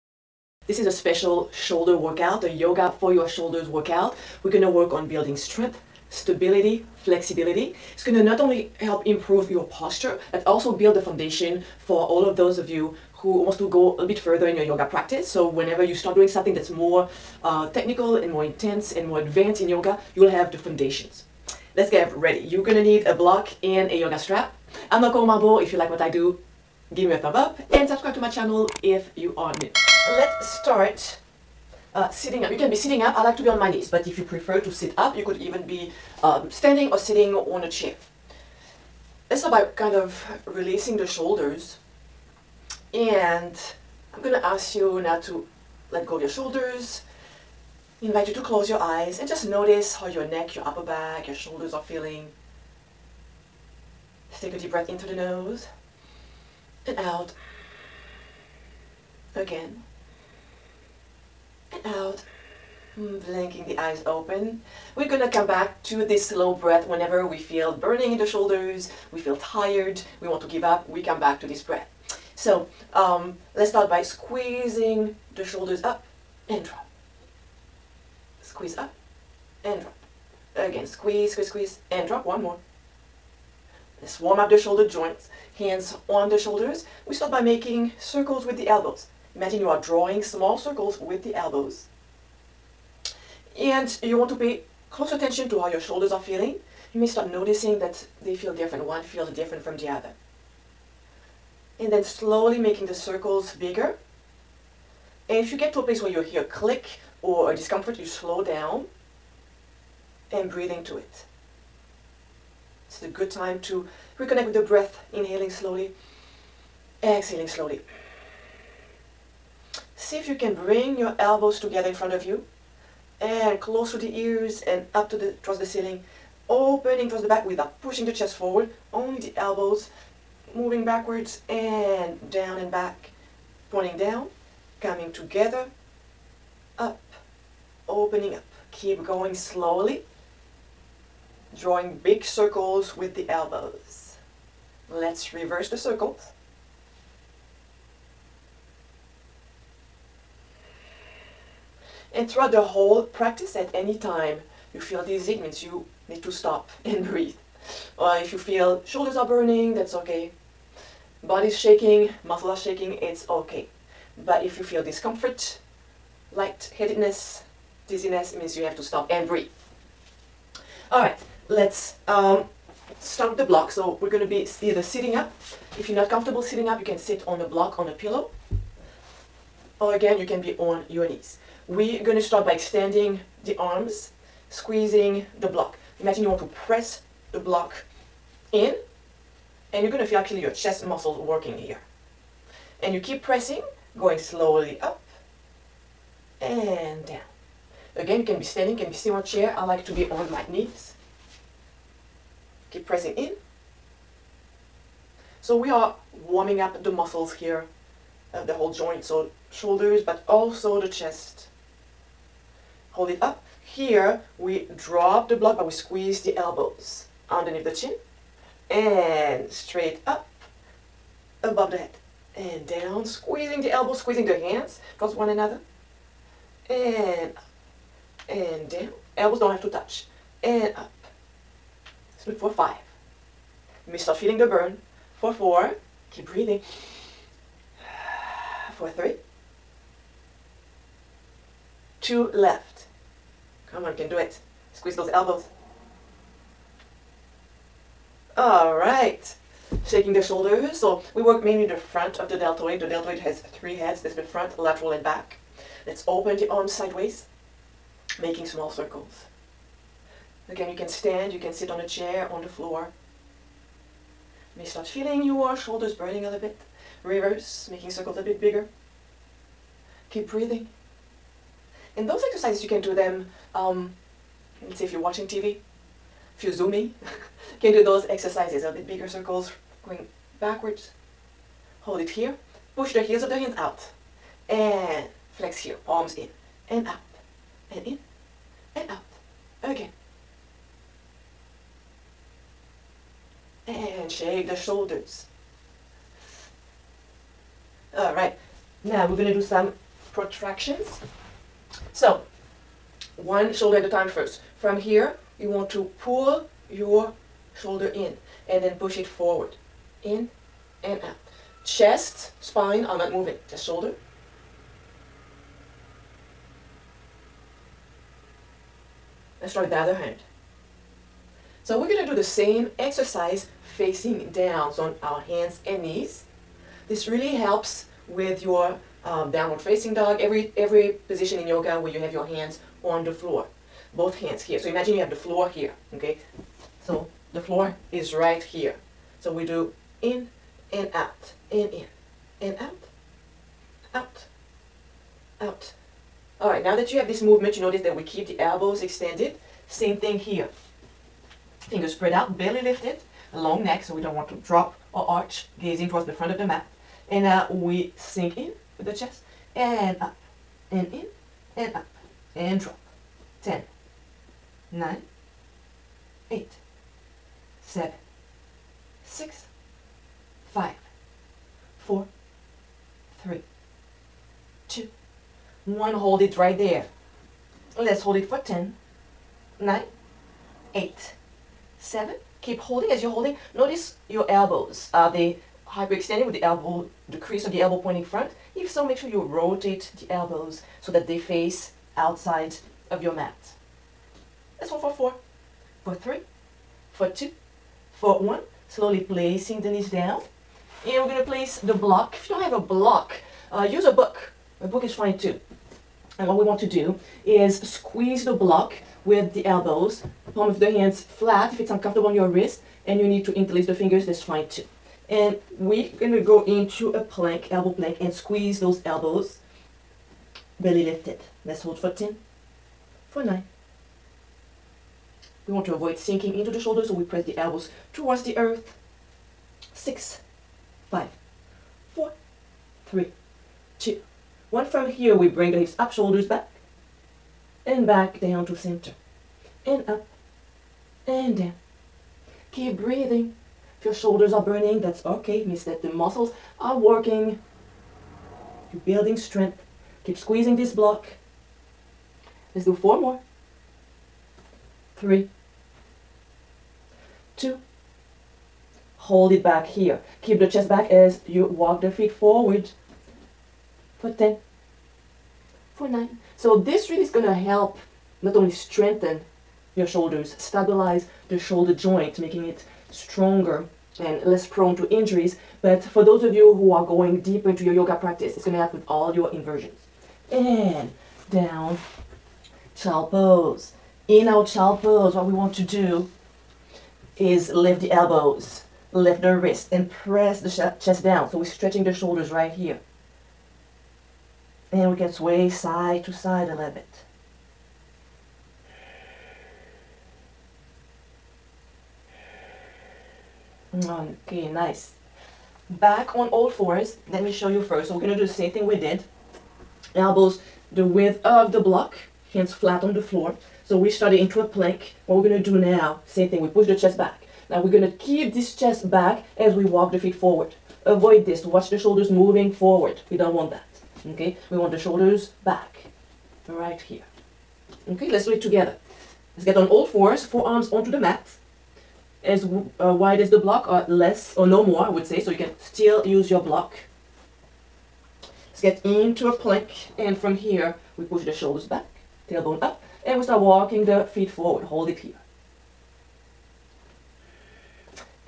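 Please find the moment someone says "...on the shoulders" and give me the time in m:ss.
1:26.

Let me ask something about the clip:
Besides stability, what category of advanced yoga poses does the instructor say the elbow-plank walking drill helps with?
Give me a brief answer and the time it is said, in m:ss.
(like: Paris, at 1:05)
Inversions, at 7:59.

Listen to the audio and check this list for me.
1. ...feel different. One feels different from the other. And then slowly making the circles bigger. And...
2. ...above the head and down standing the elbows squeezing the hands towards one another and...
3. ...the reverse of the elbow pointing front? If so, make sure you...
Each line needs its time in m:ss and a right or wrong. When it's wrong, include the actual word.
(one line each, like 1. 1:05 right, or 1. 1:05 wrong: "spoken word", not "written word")
1. 1:38 right
2. 3:41 wrong: "squeezing", not "standing"
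3. 6:27 wrong: "crease", not "reverse".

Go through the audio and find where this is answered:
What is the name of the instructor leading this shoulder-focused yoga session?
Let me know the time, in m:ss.
0:25.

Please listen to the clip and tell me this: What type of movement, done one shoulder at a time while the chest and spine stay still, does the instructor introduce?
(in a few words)
Protractions.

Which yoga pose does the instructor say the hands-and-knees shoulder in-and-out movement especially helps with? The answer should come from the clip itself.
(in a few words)
Downward facing dog.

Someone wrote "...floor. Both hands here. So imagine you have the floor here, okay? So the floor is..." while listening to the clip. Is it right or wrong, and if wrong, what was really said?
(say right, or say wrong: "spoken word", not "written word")
right.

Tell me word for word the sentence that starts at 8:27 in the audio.
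So we're gonna do the same thing we did.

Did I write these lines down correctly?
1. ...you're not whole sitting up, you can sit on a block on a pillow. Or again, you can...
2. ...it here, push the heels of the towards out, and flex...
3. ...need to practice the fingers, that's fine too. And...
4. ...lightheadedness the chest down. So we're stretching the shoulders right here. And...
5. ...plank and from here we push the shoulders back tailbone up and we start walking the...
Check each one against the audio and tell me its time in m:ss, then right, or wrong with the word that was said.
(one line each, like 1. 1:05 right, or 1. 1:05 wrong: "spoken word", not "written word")
1. 2:55 wrong: "comfortable", not "whole"
2. 4:41 wrong: "hands", not "towards"
3. 6:53 wrong: "interlace", not "practice"
4. 8:09 wrong: "press", not "lightheadedness"
5. 8:59 right.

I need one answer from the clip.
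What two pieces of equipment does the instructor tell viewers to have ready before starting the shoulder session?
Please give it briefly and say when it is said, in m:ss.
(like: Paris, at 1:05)
A block and a yoga strap, at 0:23.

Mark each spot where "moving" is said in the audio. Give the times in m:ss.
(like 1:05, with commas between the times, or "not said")
2:10, 5:13, 8:42.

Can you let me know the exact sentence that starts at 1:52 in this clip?
It's a good time to reconnect with the breath, inhaling slowly, exhaling slowly.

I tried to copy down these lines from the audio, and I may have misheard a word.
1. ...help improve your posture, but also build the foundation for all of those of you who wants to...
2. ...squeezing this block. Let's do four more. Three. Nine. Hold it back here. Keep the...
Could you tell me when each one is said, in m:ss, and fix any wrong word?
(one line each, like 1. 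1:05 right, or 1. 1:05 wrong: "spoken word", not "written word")
1. 0:08 right
2. 7:30 wrong: "Two", not "Nine".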